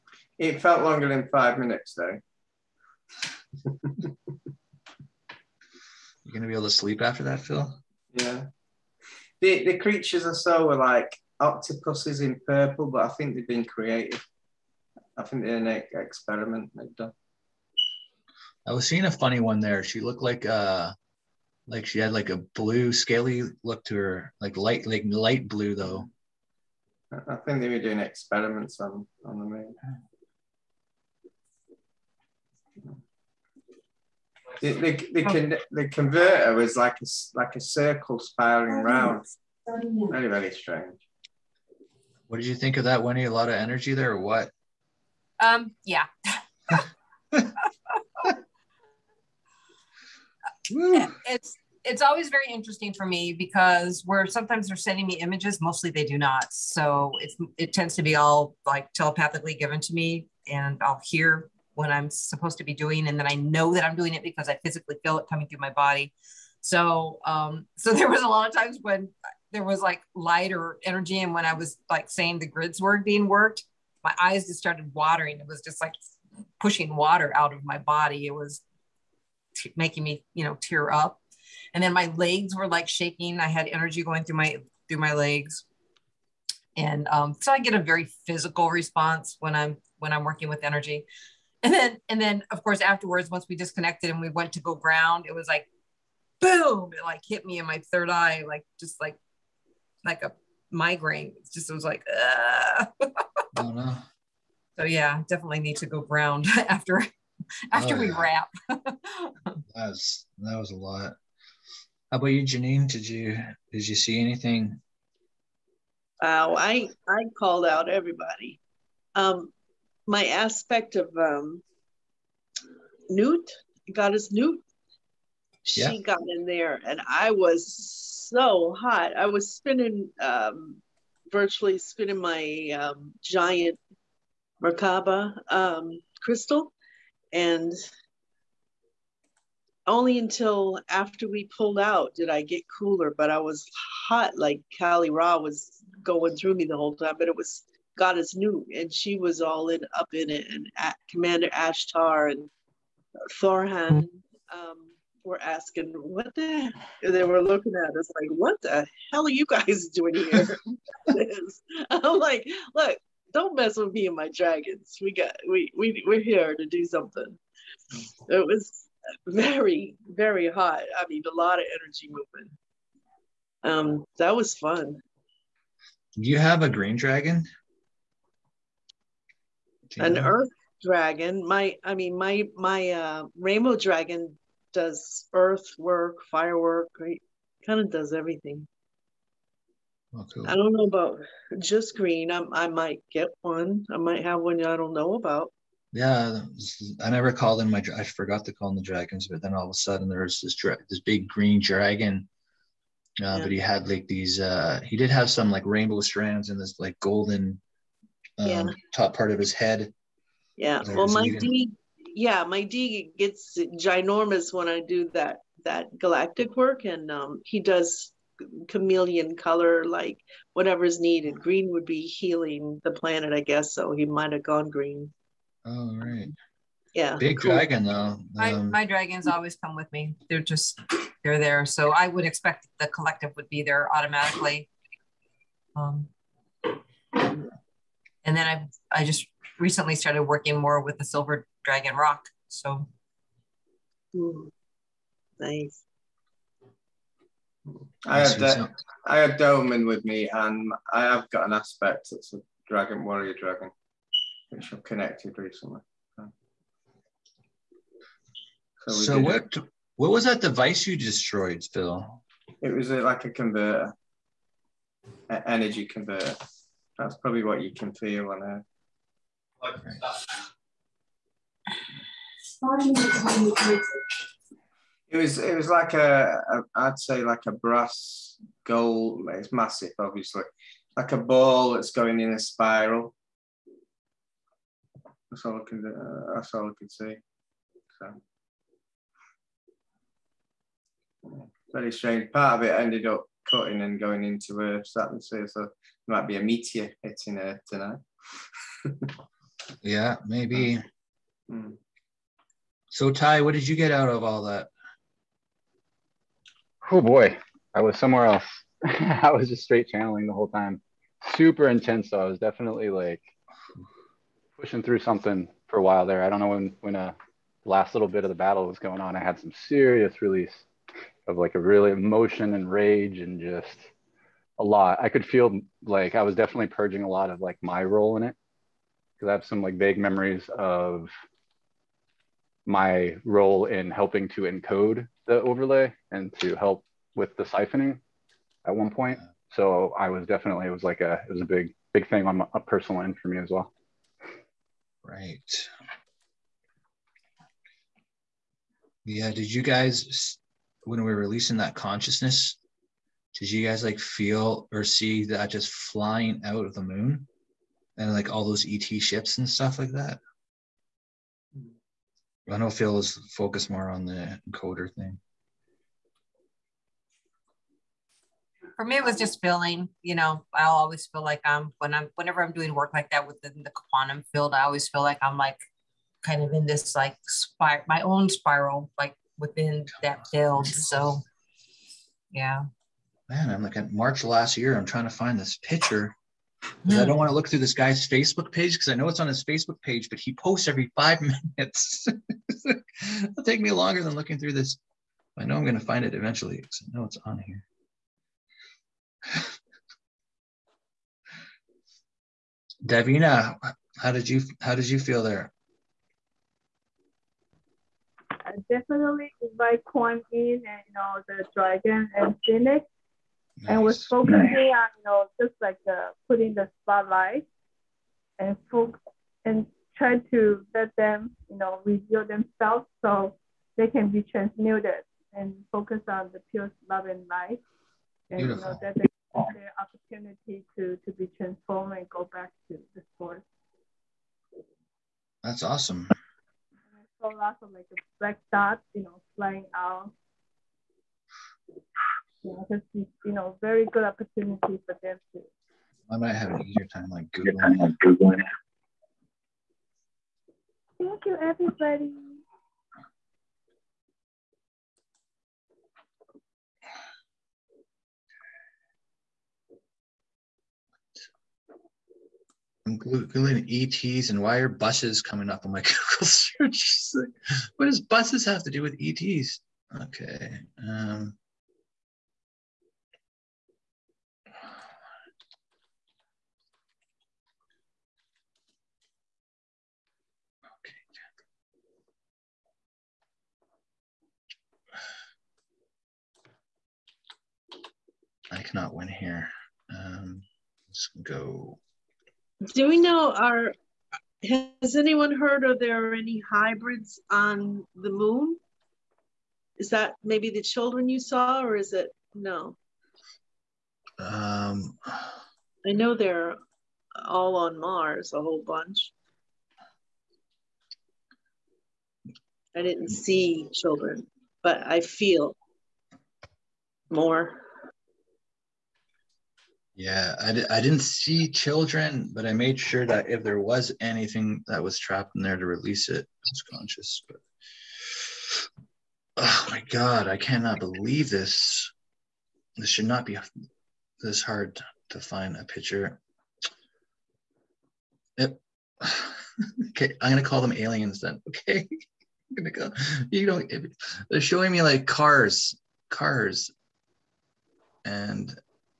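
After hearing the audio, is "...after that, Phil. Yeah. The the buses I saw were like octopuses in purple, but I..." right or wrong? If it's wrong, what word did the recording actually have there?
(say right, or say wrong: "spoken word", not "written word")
wrong: "creatures", not "buses".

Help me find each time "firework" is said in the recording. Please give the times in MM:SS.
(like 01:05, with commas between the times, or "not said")
03:06.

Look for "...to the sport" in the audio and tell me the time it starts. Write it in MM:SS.
07:12.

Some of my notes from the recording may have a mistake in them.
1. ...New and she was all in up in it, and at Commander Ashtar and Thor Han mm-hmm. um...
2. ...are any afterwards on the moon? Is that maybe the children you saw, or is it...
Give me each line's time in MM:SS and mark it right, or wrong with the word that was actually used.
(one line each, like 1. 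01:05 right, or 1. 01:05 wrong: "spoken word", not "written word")
1. 02:28 right
2. 08:16 wrong: "hybrids", not "afterwards".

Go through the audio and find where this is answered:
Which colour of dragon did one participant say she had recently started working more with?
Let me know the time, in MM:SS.
04:01.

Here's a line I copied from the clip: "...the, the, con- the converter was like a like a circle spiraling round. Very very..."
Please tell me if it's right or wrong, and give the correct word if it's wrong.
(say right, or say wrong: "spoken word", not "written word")
right.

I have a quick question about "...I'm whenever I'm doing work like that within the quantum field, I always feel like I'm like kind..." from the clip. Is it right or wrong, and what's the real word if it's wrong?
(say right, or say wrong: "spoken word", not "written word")
right.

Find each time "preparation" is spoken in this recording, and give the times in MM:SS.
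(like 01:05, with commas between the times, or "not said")
not said.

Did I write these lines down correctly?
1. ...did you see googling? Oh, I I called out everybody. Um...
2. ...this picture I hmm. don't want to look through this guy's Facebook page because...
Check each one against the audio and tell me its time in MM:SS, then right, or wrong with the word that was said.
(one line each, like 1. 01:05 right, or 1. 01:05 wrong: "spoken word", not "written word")
1. 01:53 wrong: "anything", not "googling"
2. 06:25 right.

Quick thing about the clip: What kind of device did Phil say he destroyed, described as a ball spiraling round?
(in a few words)
energy converter.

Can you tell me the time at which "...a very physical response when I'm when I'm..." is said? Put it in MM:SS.
01:27.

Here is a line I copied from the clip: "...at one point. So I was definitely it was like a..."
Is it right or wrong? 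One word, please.
right.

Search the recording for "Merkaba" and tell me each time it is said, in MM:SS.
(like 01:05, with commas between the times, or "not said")
02:14.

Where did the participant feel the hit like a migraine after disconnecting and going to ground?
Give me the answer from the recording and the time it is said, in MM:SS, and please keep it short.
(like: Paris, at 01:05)
third eye, at 01:37.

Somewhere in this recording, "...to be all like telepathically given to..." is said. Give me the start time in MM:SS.
00:57.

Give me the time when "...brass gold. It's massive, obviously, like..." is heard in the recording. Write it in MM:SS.
04:37.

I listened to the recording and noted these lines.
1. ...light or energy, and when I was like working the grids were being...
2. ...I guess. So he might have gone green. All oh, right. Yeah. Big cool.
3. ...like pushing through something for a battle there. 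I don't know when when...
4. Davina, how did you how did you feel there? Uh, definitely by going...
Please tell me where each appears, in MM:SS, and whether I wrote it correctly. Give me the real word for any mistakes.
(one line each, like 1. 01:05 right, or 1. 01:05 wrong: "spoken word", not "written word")
1. 01:10 wrong: "saying", not "working"
2. 03:43 right
3. 05:12 wrong: "while", not "battle"
4. 06:42 right.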